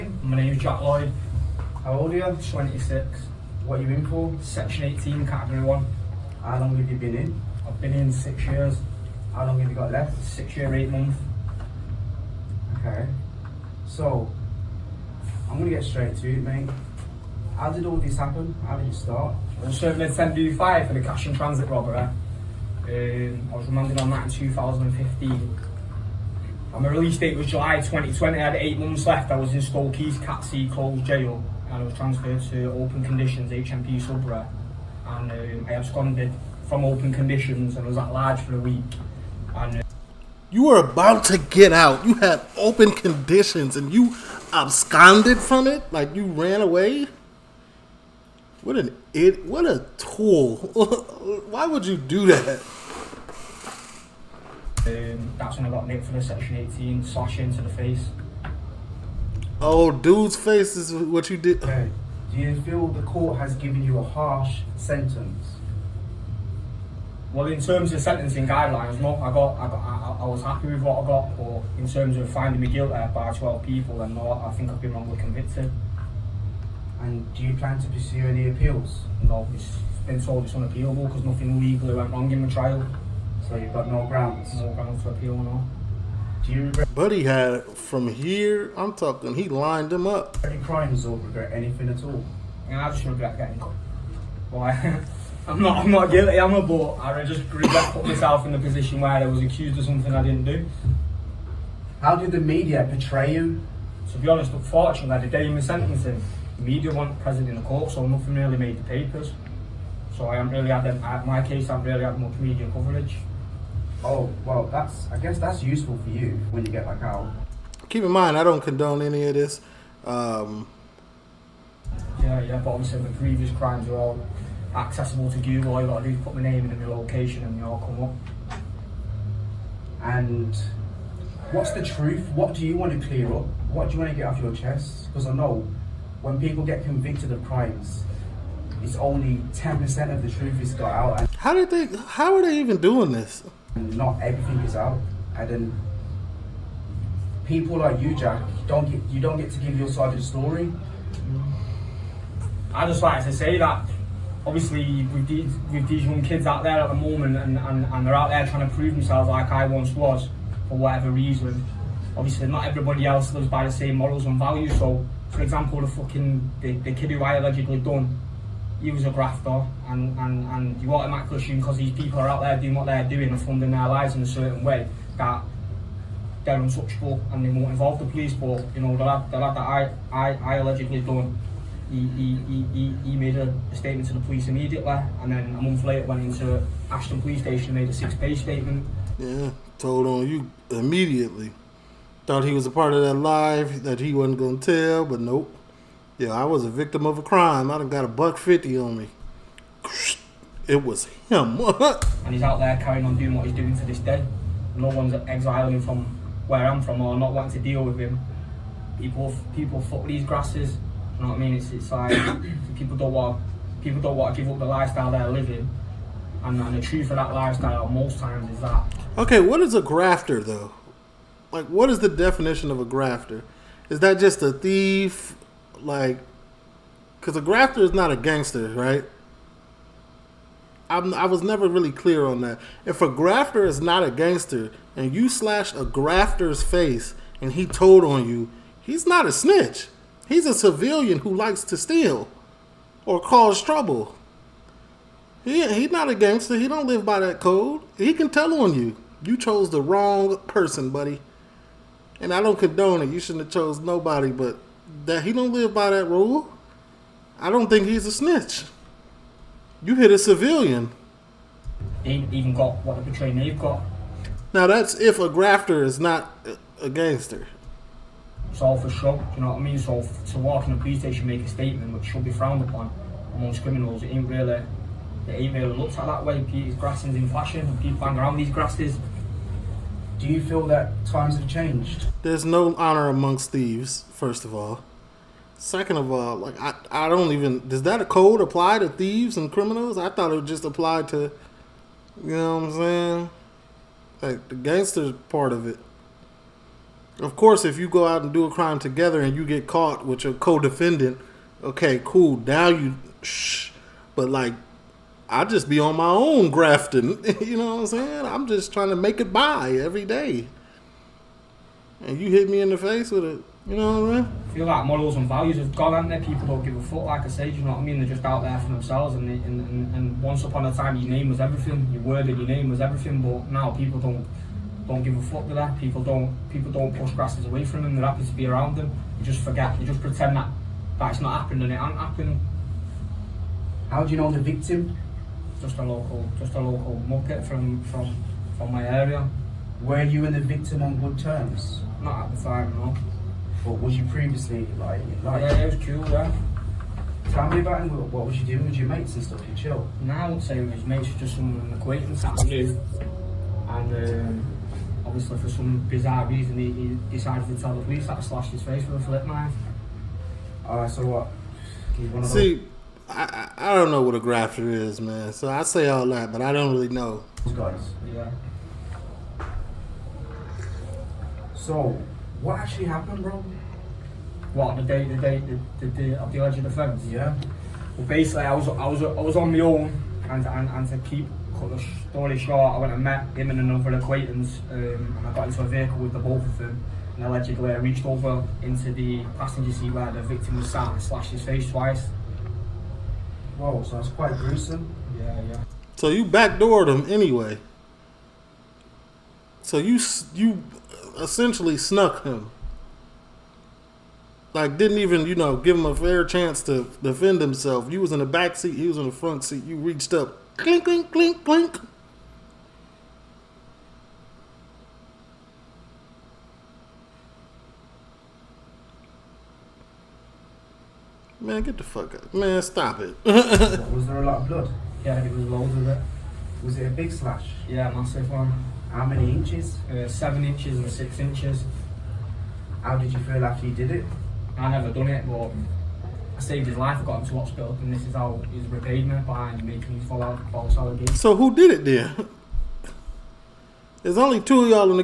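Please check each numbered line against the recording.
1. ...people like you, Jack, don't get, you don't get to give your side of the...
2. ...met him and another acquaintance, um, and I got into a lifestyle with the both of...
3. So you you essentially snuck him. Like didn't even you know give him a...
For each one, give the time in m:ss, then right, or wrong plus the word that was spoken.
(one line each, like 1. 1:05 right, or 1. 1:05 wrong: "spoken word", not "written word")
1. 2:27 right
2. 6:23 wrong: "vehicle", not "lifestyle"
3. 6:39 right.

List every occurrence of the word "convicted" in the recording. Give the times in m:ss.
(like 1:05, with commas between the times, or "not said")
1:15, 2:16.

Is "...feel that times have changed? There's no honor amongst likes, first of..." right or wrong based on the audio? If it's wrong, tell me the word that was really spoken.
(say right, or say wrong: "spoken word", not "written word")
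wrong: "thieves", not "likes".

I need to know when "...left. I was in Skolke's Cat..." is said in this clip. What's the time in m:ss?
0:29.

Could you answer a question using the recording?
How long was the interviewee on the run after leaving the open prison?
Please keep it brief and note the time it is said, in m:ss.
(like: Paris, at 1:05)
a week, at 0:38.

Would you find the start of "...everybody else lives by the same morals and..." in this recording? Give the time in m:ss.
2:42.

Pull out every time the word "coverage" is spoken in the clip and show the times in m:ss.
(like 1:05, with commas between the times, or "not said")
1:52.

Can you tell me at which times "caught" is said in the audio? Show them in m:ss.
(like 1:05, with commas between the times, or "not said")
1:33, 4:59.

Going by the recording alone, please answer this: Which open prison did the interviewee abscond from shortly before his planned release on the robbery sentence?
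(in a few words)
HMP Sudbury.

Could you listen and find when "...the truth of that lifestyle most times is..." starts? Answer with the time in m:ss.
3:36.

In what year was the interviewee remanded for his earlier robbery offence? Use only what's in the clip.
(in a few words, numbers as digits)
2015.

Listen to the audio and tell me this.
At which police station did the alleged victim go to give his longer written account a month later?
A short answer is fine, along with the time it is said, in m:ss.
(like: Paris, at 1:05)
Ashton Police Station, at 3:06.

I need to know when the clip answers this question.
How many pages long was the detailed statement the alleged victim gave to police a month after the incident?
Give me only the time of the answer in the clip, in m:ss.
3:07.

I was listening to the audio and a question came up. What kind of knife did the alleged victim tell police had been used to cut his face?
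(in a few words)
flip knife.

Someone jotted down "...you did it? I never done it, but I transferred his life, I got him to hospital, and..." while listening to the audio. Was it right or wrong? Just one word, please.
wrong.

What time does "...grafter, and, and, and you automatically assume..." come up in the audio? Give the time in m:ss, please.
2:49.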